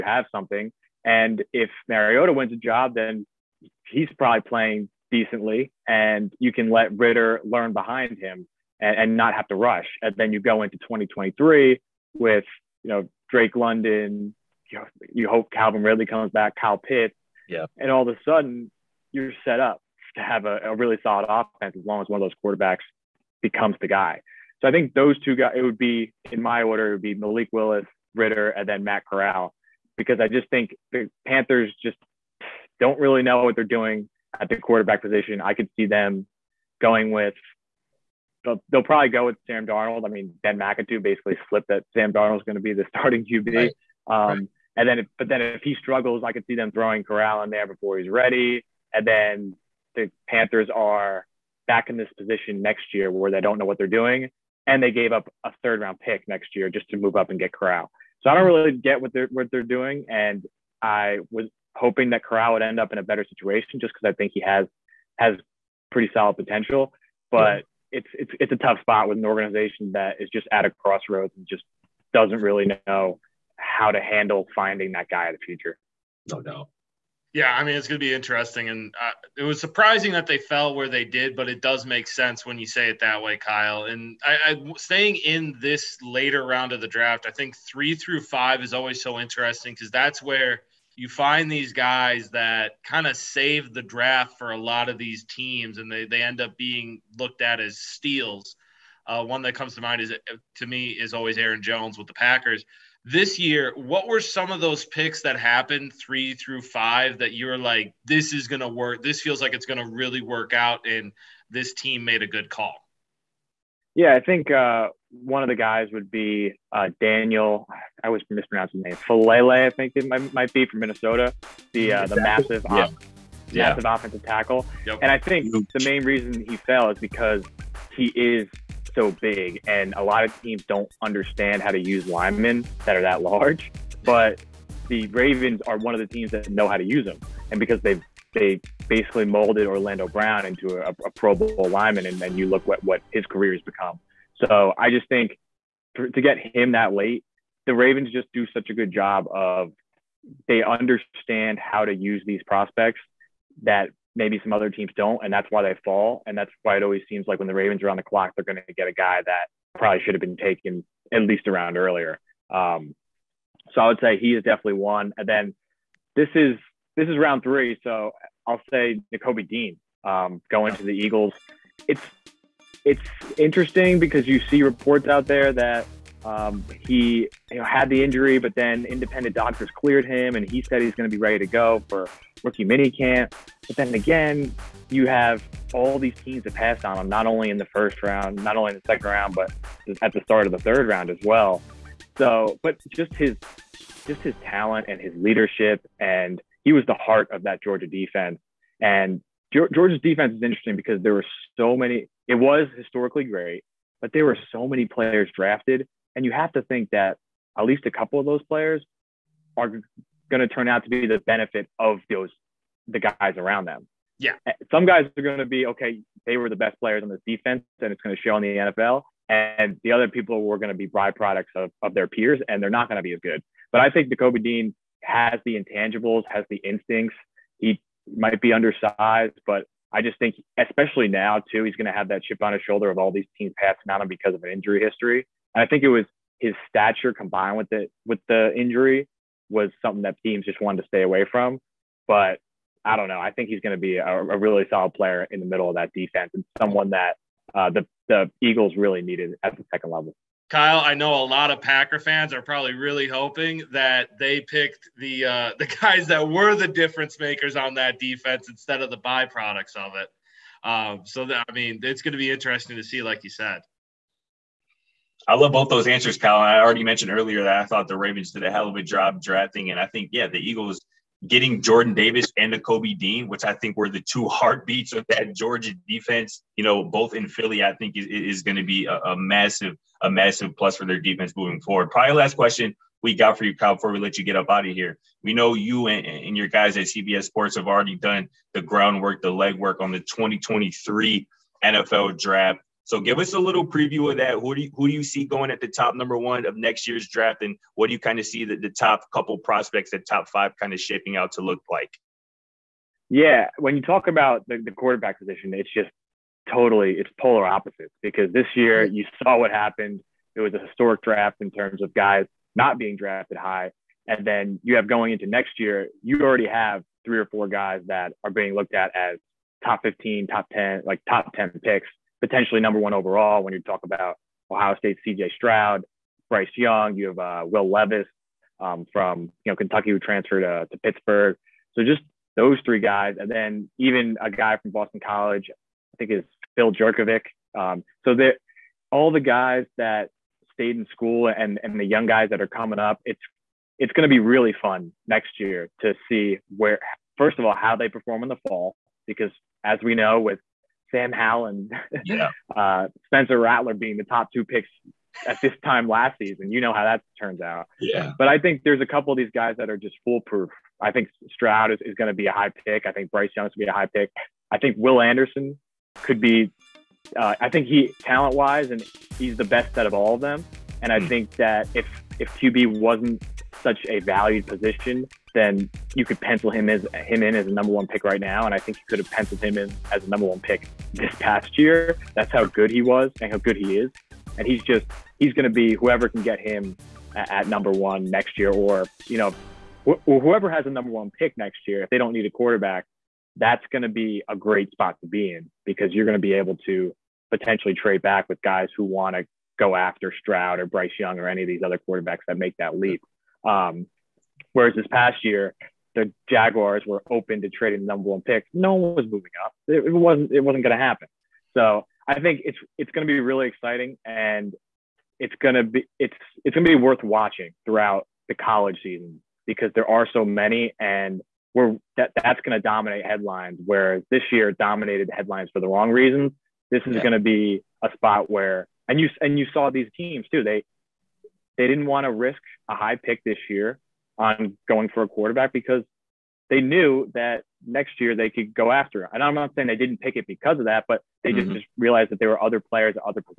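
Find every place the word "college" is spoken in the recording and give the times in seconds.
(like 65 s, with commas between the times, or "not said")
335 s, 418 s.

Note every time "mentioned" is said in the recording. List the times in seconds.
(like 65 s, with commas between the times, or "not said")
266 s.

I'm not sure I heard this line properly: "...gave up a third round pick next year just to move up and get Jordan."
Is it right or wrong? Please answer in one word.
wrong.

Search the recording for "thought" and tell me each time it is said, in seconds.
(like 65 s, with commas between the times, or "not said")
267 s.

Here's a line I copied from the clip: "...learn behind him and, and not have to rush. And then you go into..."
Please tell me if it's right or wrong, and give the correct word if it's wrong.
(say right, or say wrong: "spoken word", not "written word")
right.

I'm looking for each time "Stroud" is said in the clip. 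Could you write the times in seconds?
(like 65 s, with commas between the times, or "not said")
325 s, 361 s, 400 s.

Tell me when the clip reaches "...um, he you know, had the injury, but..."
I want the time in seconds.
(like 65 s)
176 s.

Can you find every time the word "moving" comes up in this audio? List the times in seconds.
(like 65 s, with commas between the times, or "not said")
281 s, 409 s.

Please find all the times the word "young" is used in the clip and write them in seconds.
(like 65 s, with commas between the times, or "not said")
326 s, 341 s, 400 s.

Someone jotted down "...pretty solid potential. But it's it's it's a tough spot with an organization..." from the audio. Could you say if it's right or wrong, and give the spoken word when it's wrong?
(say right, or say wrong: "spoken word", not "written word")
right.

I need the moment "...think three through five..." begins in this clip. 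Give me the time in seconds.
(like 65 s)
87 s.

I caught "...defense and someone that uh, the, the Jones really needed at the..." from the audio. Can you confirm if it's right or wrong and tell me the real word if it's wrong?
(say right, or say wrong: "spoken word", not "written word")
wrong: "Eagles", not "Jones".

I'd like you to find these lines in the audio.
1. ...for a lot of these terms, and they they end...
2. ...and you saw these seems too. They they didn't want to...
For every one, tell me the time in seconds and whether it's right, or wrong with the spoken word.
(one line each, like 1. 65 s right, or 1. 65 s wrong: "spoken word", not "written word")
1. 94 s wrong: "teams", not "terms"
2. 429 s wrong: "teams", not "seems".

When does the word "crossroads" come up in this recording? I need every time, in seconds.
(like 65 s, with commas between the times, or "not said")
70 s.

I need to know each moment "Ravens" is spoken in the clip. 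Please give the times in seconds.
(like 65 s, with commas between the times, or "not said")
135 s, 147 s, 157 s, 267 s.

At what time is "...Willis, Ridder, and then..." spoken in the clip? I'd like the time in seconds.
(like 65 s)
27 s.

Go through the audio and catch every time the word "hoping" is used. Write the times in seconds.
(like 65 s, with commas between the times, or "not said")
61 s, 253 s.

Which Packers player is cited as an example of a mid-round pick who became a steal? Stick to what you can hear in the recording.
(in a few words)
Aaron Jones.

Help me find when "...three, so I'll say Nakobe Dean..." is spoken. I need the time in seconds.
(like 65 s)
167 s.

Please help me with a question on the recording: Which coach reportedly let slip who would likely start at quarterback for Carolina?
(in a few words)
Ben McAdoo.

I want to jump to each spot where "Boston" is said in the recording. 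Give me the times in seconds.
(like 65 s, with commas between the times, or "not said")
334 s.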